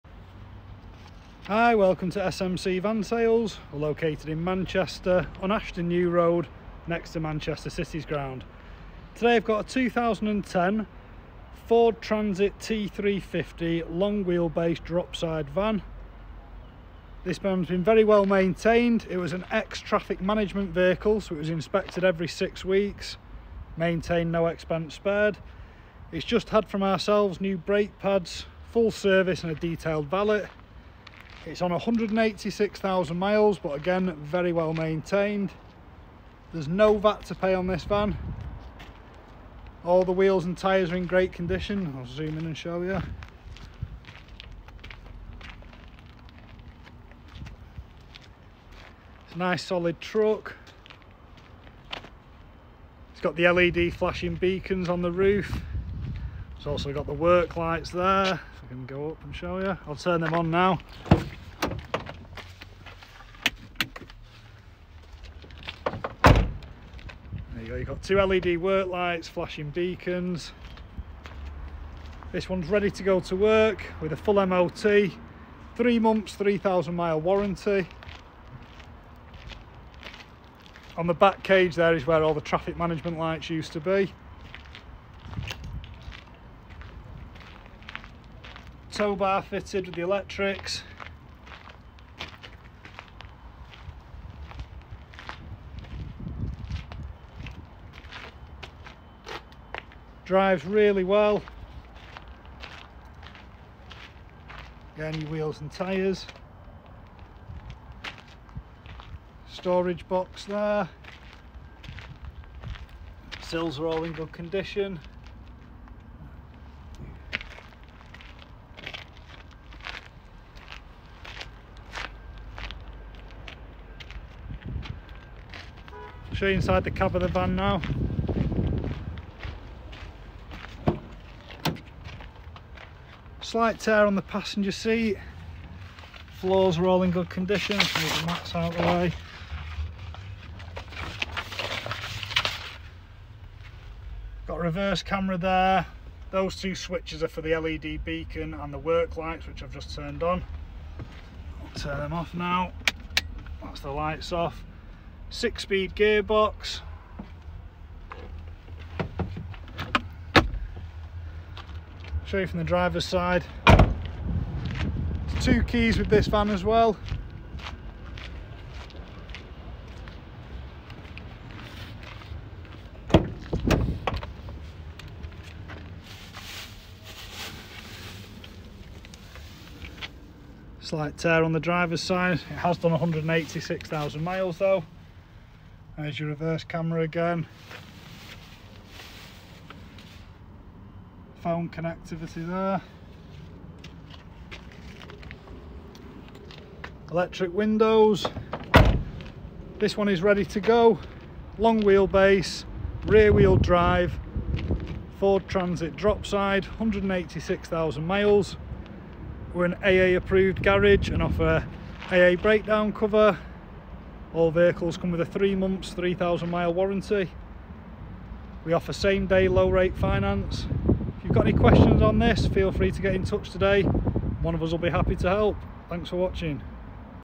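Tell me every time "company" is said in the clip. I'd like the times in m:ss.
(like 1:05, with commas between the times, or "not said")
not said.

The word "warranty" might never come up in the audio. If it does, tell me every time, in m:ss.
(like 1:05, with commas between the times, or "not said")
1:17, 3:36.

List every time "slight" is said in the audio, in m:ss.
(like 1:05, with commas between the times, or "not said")
2:13, 3:00.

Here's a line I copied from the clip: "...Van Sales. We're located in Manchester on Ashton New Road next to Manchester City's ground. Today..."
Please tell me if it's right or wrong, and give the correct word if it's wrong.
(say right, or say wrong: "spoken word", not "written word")
right.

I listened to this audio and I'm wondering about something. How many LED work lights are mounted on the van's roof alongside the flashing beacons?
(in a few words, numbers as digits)
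2.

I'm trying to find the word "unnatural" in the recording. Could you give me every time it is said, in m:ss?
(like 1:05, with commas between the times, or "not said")
not said.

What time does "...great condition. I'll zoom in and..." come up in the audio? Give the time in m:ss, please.
0:41.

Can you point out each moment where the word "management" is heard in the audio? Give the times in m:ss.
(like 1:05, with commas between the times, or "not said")
0:20, 1:22.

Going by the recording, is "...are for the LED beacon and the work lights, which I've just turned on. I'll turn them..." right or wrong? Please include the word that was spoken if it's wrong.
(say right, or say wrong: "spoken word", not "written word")
right.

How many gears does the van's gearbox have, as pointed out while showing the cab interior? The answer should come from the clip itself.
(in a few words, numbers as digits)
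6.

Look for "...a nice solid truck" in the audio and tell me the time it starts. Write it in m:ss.
0:49.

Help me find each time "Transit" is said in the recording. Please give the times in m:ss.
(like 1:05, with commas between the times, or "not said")
0:11, 3:25.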